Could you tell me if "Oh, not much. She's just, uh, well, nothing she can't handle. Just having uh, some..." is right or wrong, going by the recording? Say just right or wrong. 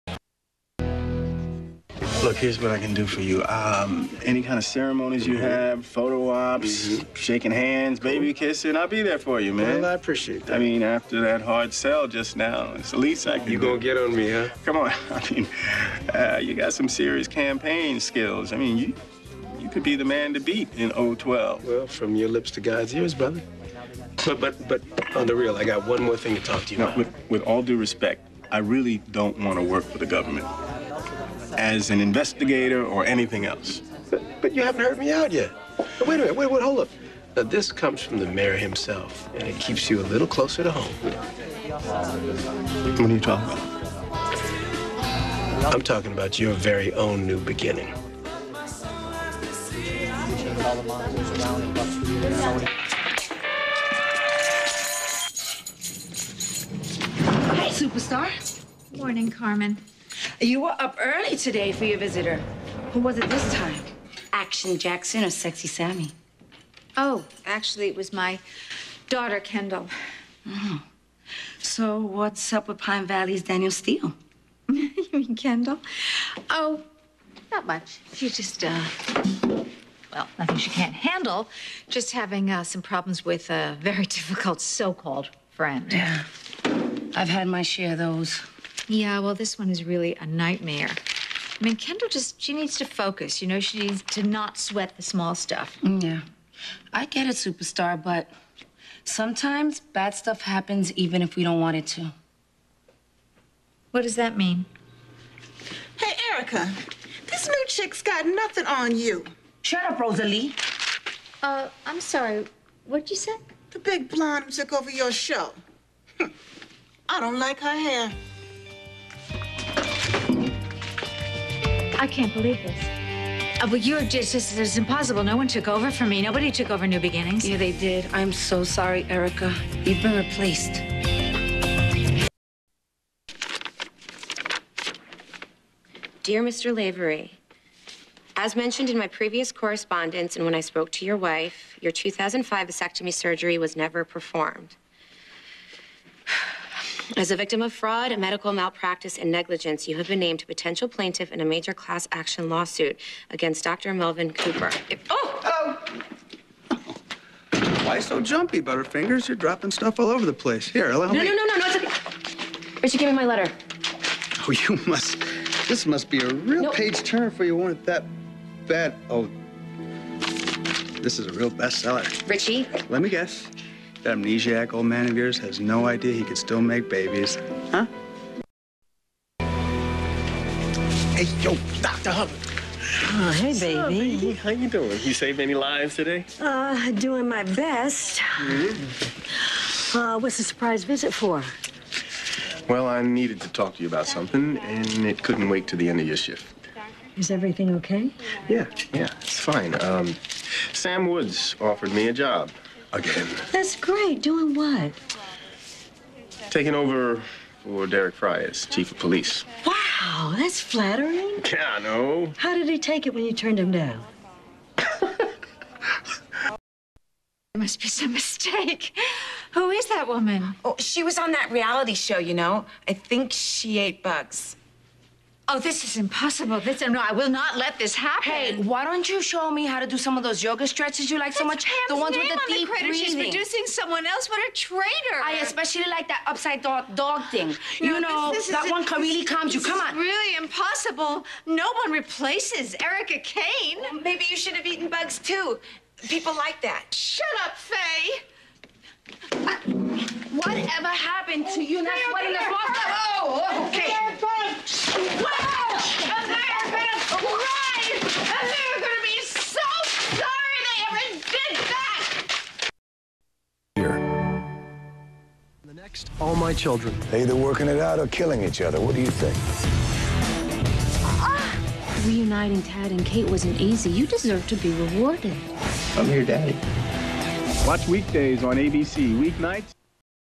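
right.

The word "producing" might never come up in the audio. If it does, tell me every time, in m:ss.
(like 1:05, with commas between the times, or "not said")
3:53.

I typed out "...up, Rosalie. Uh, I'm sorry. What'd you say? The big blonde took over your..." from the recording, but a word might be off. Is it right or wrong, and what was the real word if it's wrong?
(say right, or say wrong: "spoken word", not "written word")
right.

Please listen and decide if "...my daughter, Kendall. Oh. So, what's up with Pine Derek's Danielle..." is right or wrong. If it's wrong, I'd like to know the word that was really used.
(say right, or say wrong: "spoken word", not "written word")
wrong: "Valley", not "Derek".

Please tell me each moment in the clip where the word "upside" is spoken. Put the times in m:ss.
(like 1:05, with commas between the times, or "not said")
3:56.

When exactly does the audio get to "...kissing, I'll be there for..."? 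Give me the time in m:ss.
0:08.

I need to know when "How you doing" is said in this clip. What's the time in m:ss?
3:04.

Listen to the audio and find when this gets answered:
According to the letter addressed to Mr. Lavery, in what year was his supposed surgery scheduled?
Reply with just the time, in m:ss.
2:21.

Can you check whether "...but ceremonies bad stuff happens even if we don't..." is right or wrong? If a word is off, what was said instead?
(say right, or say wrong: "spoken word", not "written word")
wrong: "sometimes", not "ceremonies".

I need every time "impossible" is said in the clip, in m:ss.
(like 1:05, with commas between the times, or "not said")
2:04, 3:45, 4:00.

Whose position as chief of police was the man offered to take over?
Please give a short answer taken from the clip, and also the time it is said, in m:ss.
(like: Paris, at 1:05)
Derek Frye, at 3:27.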